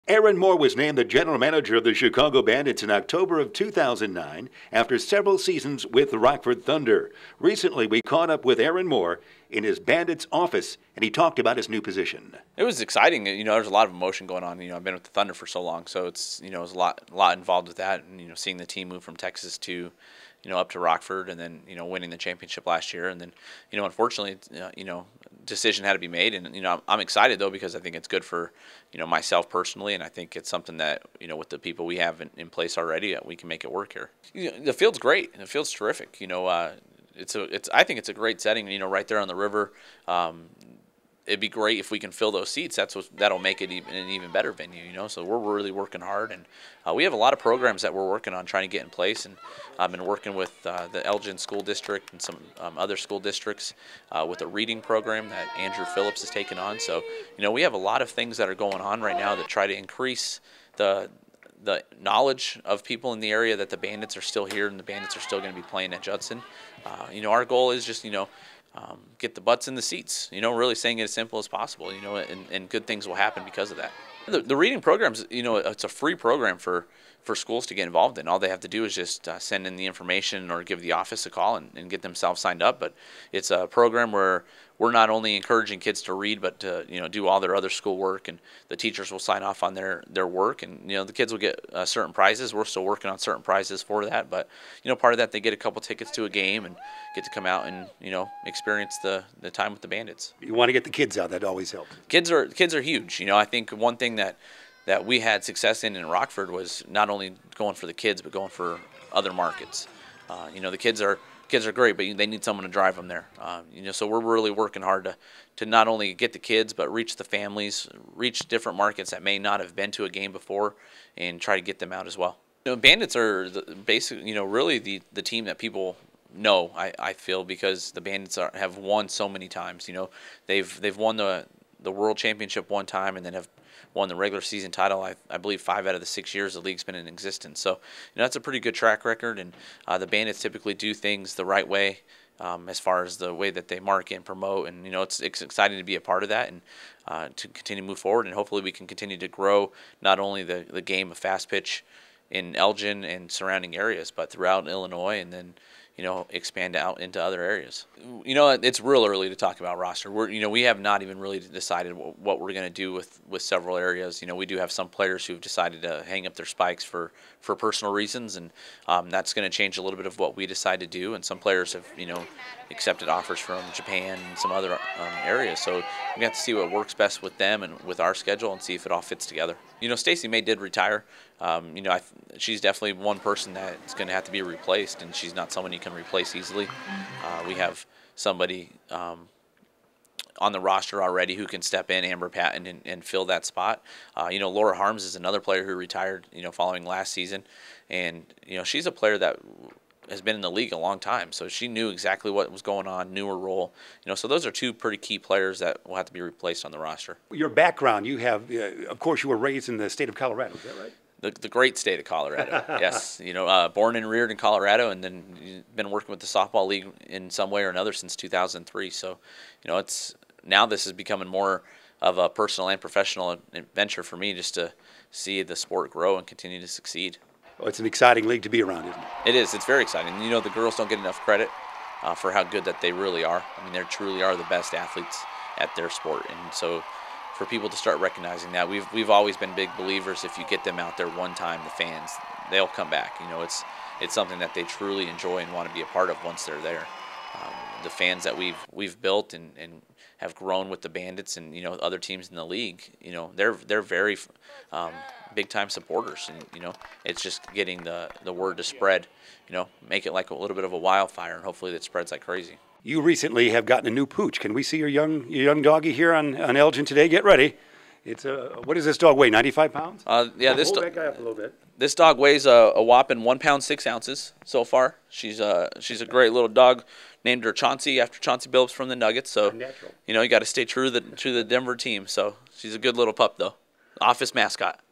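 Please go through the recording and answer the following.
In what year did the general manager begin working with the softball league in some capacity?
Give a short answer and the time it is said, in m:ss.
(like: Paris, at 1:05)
2003, at 3:38.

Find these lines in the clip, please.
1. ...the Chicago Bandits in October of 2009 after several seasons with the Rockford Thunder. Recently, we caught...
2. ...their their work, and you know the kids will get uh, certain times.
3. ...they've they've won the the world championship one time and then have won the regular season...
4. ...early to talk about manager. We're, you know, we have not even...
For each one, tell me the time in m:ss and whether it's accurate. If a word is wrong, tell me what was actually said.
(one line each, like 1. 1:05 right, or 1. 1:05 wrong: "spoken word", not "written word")
1. 0:01 right
2. 1:29 wrong: "prizes", not "times"
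3. 2:10 right
4. 2:39 wrong: "roster", not "manager".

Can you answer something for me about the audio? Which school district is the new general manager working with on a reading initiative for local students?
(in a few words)
Elgin School District.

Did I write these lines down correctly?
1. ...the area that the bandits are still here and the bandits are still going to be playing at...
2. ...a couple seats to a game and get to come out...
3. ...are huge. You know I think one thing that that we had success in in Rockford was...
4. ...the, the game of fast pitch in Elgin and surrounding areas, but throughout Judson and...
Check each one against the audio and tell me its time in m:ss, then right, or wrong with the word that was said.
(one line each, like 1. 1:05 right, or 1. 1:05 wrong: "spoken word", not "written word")
1. 1:03 right
2. 1:35 wrong: "tickets", not "seats"
3. 1:42 right
4. 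2:30 wrong: "Illinois", not "Judson".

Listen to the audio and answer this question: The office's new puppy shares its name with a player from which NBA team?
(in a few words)
Nuggets.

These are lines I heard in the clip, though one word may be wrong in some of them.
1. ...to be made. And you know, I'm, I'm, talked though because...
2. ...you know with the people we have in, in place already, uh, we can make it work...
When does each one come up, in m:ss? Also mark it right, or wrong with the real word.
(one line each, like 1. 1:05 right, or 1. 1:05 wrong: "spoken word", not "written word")
1. 0:25 wrong: "excited", not "talked"
2. 0:31 right.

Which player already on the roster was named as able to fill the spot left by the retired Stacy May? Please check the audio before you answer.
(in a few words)
Amber Patton.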